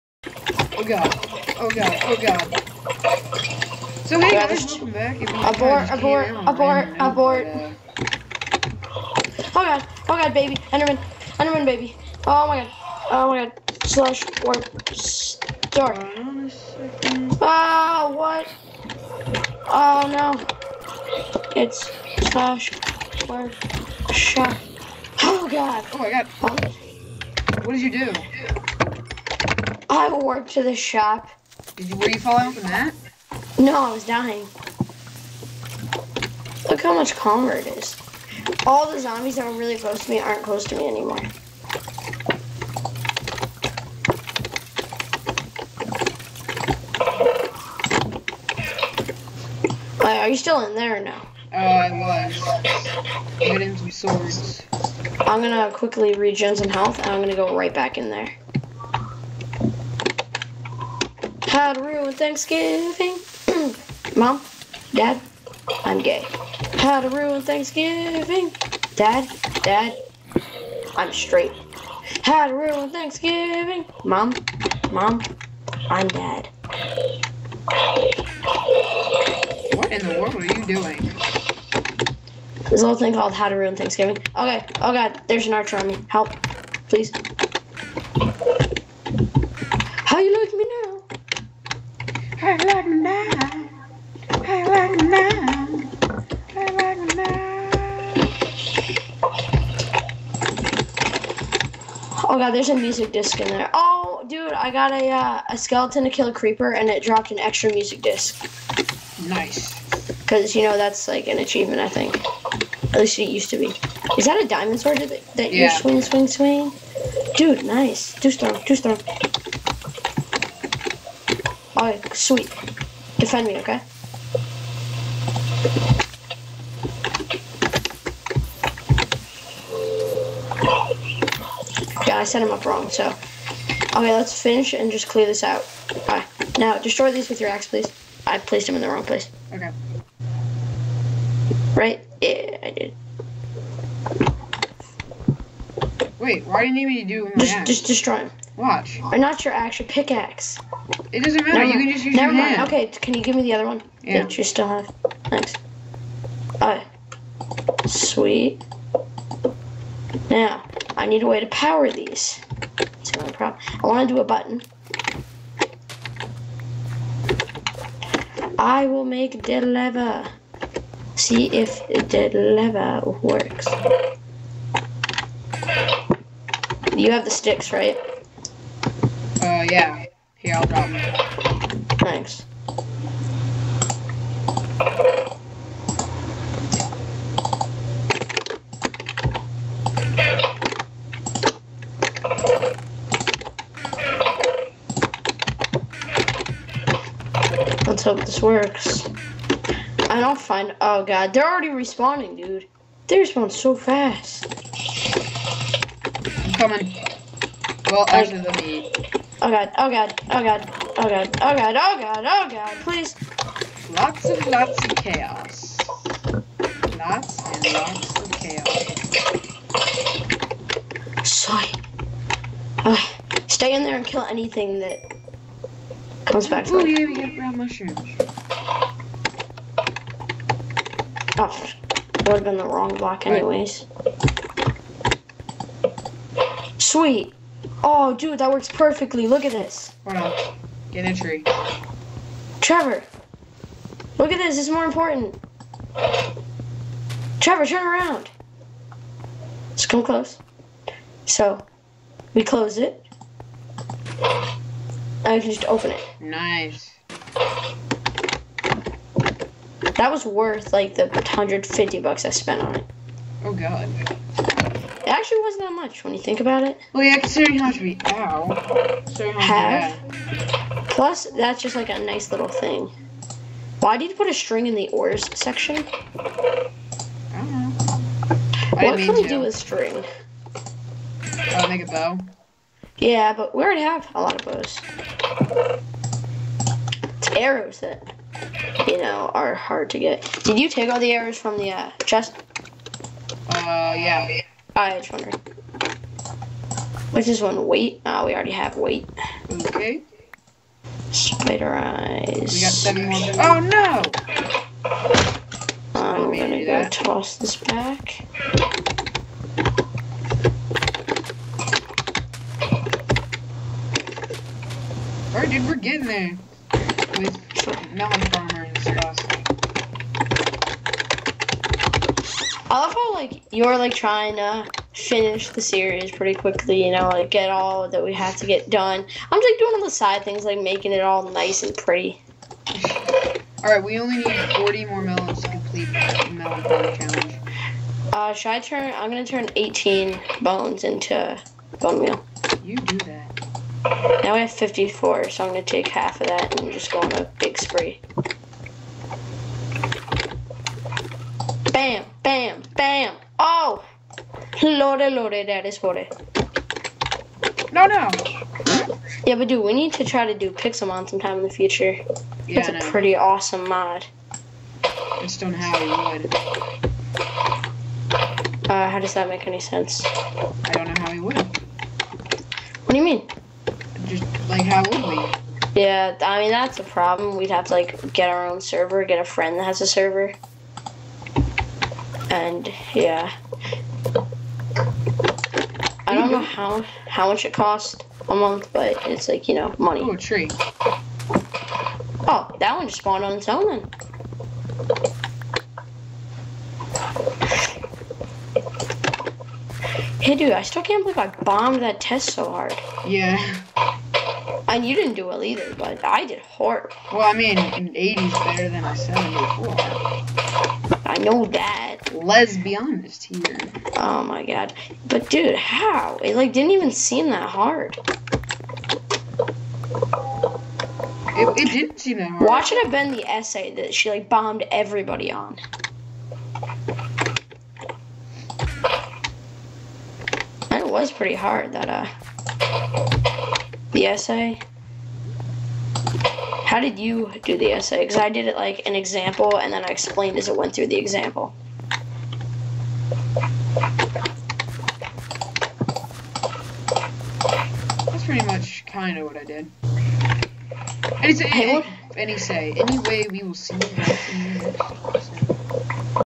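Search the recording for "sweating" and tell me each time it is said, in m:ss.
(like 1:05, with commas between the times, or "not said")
not said.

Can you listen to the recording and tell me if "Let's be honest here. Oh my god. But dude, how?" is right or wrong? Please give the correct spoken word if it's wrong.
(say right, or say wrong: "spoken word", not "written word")
right.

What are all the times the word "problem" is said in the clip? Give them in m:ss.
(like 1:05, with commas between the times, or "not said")
2:43, 6:16.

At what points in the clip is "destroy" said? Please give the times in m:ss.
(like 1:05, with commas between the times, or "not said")
2:16, 2:27.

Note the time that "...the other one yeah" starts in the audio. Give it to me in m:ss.
2:33.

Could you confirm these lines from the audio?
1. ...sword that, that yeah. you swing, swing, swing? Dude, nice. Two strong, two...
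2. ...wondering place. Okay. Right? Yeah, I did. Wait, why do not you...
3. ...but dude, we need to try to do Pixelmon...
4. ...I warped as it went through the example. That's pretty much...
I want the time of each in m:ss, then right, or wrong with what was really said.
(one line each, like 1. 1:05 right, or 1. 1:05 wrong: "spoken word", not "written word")
1. 1:54 right
2. 2:18 wrong: "wrong", not "wondering"
3. 5:59 right
4. 7:19 wrong: "explained", not "warped".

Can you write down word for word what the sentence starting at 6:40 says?
Hey, dude, I still can't believe I bombed that test so hard.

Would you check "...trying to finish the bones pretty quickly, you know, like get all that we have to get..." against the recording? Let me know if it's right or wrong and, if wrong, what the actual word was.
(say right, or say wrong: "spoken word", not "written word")
wrong: "series", not "bones".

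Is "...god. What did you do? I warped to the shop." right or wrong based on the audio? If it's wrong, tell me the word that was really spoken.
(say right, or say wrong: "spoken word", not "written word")
right.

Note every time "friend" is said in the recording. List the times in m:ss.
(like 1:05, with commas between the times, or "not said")
6:19.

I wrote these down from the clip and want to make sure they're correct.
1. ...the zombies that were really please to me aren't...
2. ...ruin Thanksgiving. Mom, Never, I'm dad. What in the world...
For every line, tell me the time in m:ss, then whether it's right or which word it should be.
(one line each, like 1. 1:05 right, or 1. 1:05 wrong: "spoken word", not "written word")
1. 0:38 wrong: "close", not "please"
2. 1:12 wrong: "Mom", not "Never".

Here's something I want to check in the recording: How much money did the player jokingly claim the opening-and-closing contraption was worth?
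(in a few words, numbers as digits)
150 bucks.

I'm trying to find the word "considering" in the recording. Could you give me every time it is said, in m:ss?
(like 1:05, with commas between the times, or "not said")
4:27.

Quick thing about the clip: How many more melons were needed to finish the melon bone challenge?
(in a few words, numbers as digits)
40.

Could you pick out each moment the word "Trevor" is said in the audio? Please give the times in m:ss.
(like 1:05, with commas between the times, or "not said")
4:02, 4:07.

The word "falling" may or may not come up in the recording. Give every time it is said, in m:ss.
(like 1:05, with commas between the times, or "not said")
0:32.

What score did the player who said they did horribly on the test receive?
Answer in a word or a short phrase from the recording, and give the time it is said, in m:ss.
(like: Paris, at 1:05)
74, at 6:48.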